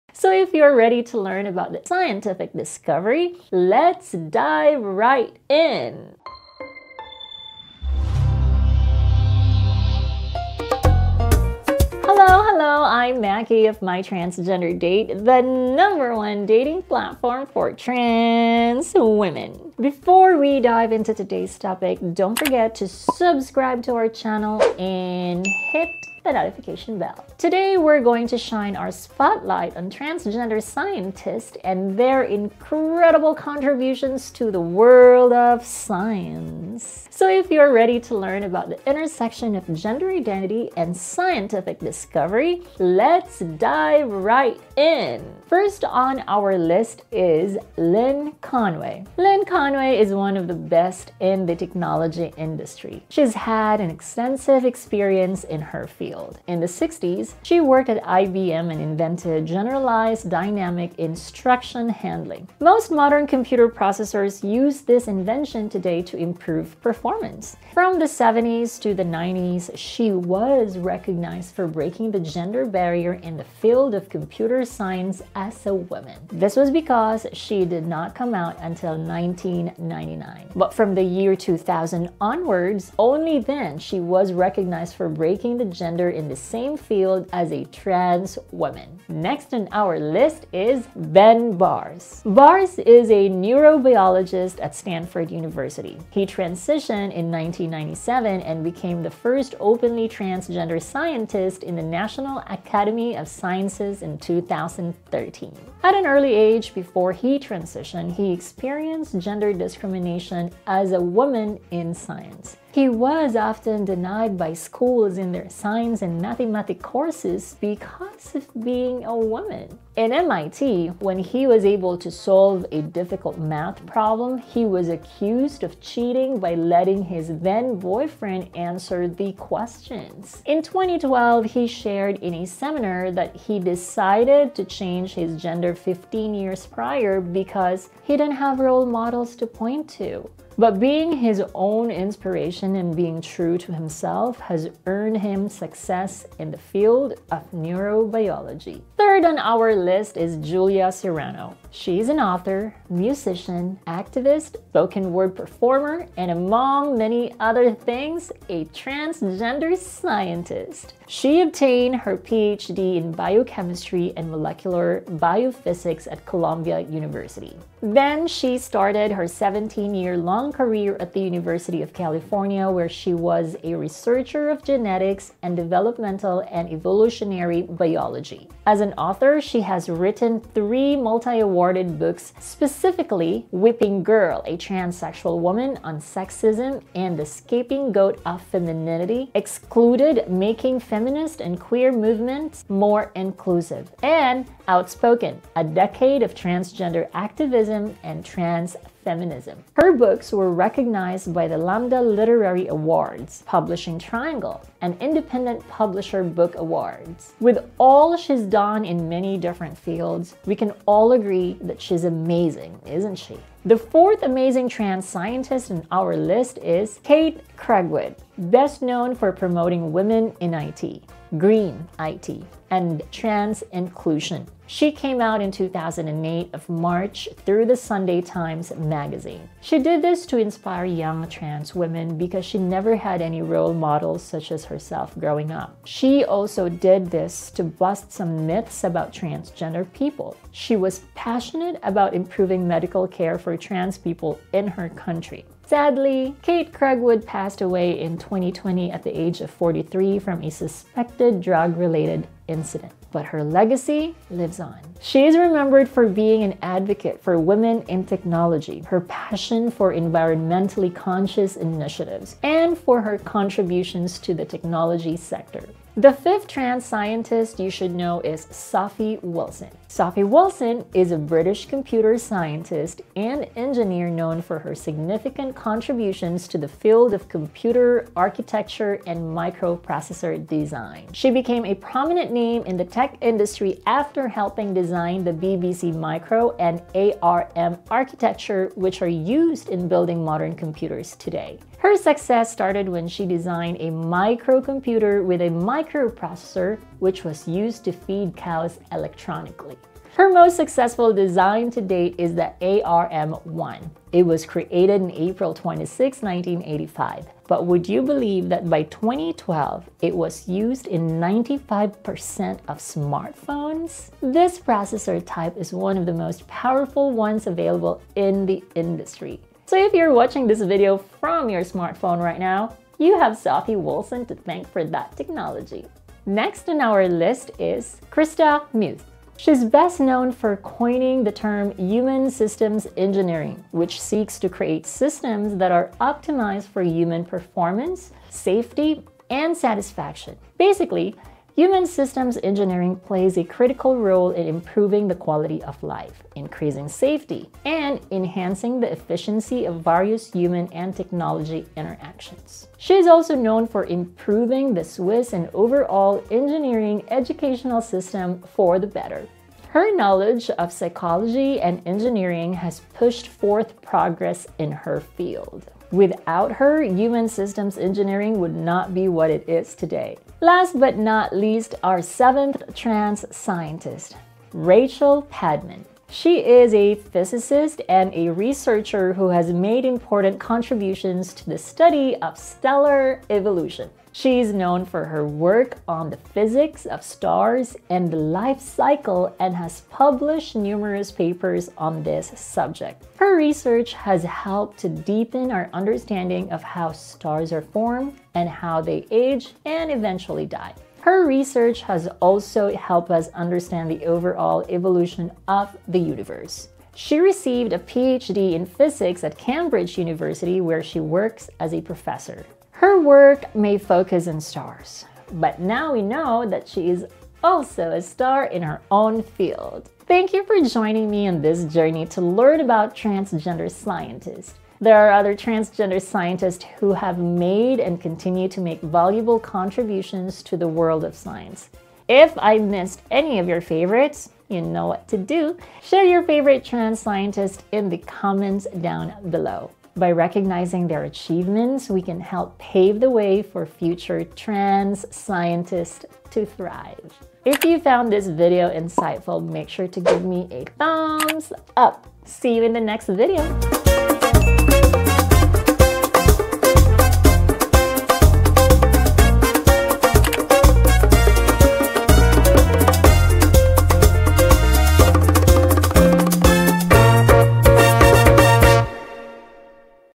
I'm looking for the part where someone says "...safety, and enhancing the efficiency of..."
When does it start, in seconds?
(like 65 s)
346 s.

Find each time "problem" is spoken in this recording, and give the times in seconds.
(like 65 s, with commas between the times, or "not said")
123 s.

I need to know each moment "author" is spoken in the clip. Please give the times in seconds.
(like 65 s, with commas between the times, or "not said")
152 s, 178 s.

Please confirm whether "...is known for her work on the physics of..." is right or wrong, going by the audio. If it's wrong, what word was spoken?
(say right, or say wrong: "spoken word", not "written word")
right.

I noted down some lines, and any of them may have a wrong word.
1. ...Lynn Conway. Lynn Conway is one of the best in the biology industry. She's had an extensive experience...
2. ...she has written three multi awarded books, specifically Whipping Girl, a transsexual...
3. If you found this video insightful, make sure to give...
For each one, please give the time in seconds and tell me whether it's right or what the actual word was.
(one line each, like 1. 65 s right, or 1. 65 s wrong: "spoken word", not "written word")
1. 47 s wrong: "technology", not "biology"
2. 179 s right
3. 447 s right.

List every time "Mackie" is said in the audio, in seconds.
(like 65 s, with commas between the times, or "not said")
13 s.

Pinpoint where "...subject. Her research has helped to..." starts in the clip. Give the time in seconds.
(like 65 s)
392 s.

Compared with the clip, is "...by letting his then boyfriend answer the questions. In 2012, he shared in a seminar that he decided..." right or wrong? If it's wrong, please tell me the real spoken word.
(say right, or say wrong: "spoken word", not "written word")
right.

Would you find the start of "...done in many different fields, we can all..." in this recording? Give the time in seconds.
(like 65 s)
208 s.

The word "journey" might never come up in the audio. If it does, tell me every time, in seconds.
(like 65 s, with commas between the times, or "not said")
421 s.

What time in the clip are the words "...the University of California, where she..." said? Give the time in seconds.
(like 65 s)
171 s.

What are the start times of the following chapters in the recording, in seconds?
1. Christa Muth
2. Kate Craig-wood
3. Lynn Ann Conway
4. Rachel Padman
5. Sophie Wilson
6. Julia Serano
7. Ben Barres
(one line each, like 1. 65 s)
1. 328 s
2. 217 s
3. 48 s
4. 375 s
5. 268 s
6. 150 s
7. 91 s.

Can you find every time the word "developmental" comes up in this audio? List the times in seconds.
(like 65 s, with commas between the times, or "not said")
175 s.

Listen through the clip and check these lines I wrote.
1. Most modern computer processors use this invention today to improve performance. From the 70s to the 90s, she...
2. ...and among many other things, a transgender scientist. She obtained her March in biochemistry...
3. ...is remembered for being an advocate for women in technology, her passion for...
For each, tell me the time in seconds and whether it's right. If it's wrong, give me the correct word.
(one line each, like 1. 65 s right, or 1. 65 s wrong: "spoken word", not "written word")
1. 62 s right
2. 156 s wrong: "PhD", not "March"
3. 255 s right.